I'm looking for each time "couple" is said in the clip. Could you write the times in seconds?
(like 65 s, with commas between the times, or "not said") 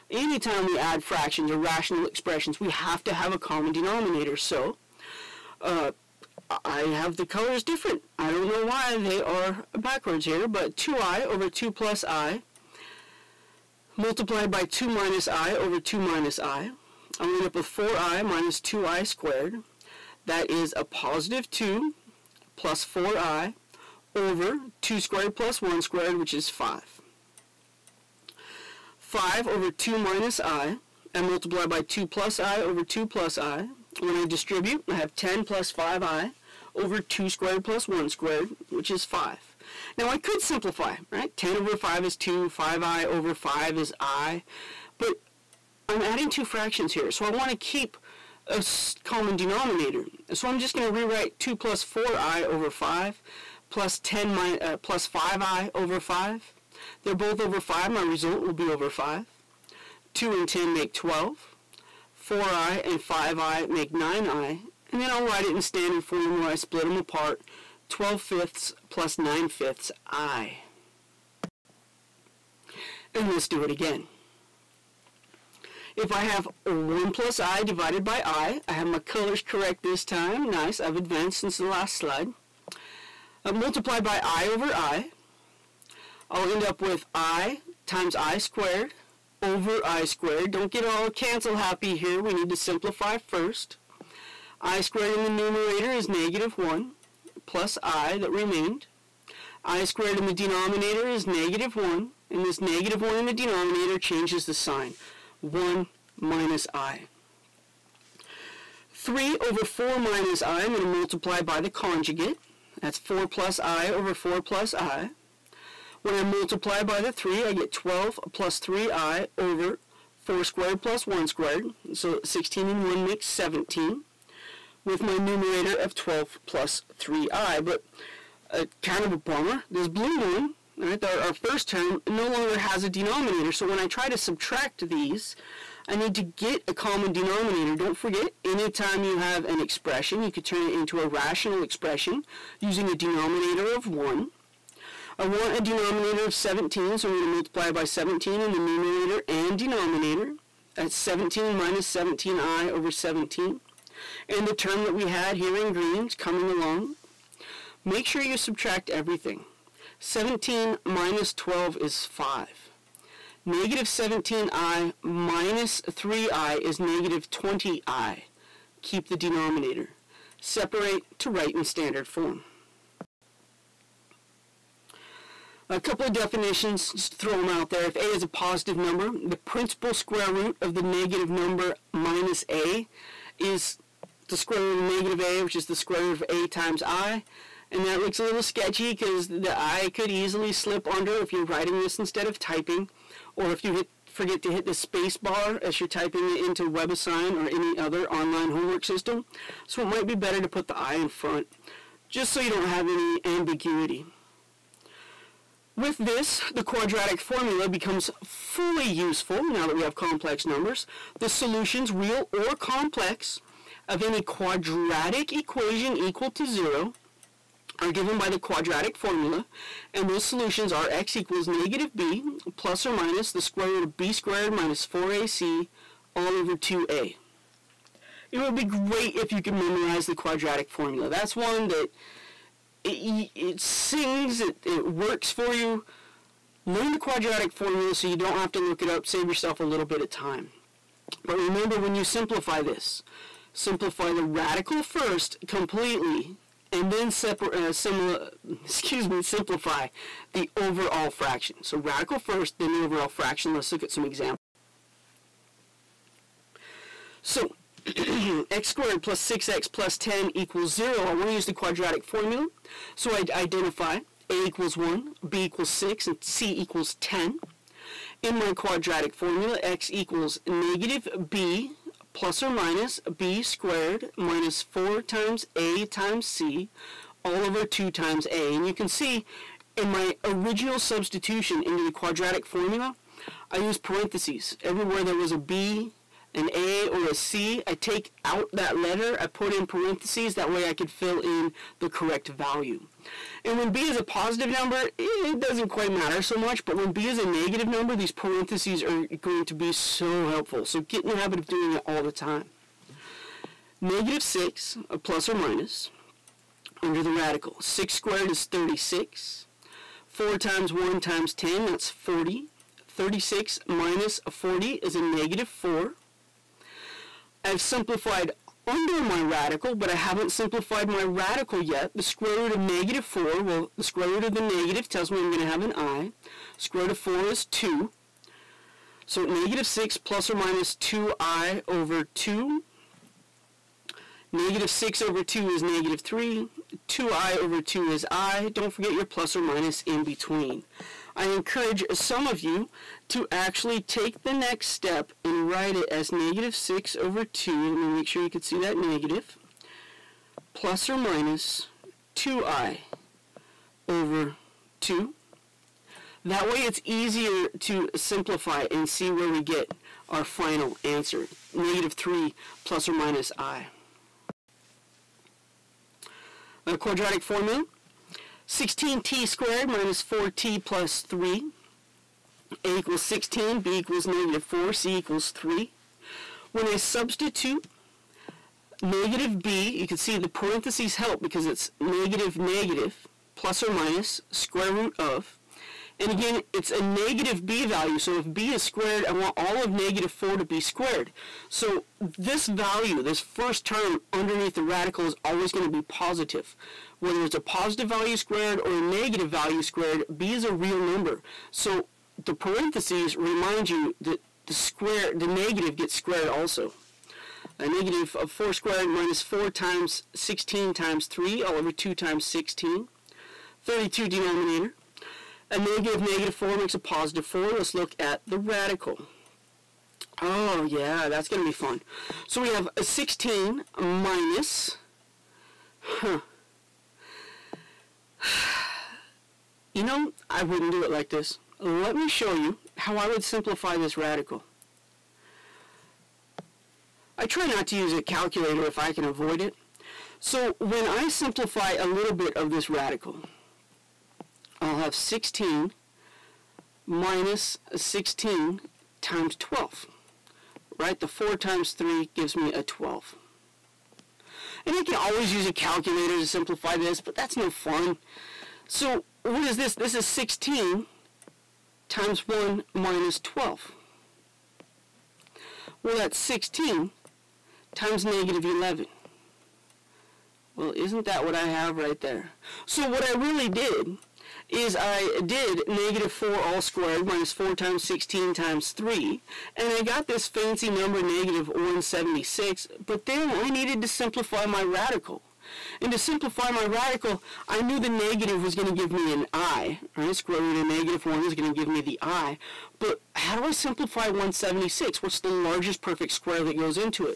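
175 s.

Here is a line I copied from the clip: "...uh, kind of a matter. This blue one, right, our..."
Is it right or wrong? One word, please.
wrong.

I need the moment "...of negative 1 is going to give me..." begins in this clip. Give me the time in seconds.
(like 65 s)
490 s.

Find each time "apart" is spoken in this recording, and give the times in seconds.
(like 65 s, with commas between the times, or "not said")
66 s.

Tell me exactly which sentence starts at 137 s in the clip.
Don't forget, anytime you have an expression, you could turn it into a rational expression using a denominator of 1.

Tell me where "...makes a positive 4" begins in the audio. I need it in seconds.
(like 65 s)
416 s.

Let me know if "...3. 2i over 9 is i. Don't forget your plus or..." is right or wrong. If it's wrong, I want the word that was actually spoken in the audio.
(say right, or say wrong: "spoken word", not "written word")
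wrong: "2", not "9".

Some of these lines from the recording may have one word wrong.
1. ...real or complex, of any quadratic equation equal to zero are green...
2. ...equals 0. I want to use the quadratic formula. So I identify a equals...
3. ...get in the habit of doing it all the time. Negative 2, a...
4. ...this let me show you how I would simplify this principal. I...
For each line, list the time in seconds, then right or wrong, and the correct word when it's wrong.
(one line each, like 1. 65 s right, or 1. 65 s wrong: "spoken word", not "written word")
1. 211 s wrong: "given", not "green"
2. 260 s right
3. 300 s wrong: "6", not "2"
4. 431 s wrong: "radical", not "principal".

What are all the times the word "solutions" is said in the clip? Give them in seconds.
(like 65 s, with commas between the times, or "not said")
211 s, 220 s.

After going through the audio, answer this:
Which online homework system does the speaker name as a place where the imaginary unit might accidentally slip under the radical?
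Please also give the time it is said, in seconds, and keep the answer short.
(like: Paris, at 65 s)
WebAssign, at 196 s.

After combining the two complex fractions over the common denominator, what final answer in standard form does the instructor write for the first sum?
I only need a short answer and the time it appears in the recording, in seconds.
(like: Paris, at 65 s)
12/5 + 9/5 i, at 67 s.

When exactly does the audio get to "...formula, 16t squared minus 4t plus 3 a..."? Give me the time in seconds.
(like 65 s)
367 s.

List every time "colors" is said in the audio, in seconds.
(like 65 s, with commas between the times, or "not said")
7 s, 78 s.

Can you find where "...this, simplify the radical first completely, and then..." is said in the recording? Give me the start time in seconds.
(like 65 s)
242 s.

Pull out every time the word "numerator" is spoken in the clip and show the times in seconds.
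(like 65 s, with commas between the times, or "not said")
95 s, 125 s, 148 s.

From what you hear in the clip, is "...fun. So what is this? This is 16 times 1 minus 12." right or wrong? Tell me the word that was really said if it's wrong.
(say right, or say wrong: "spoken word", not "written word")
right.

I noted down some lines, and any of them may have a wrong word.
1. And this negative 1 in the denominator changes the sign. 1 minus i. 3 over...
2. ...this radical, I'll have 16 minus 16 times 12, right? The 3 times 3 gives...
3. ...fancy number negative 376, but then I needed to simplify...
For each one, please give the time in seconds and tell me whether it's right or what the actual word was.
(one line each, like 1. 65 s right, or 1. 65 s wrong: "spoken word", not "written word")
1. 102 s right
2. 442 s wrong: "4", not "3"
3. 480 s wrong: "176", not "376".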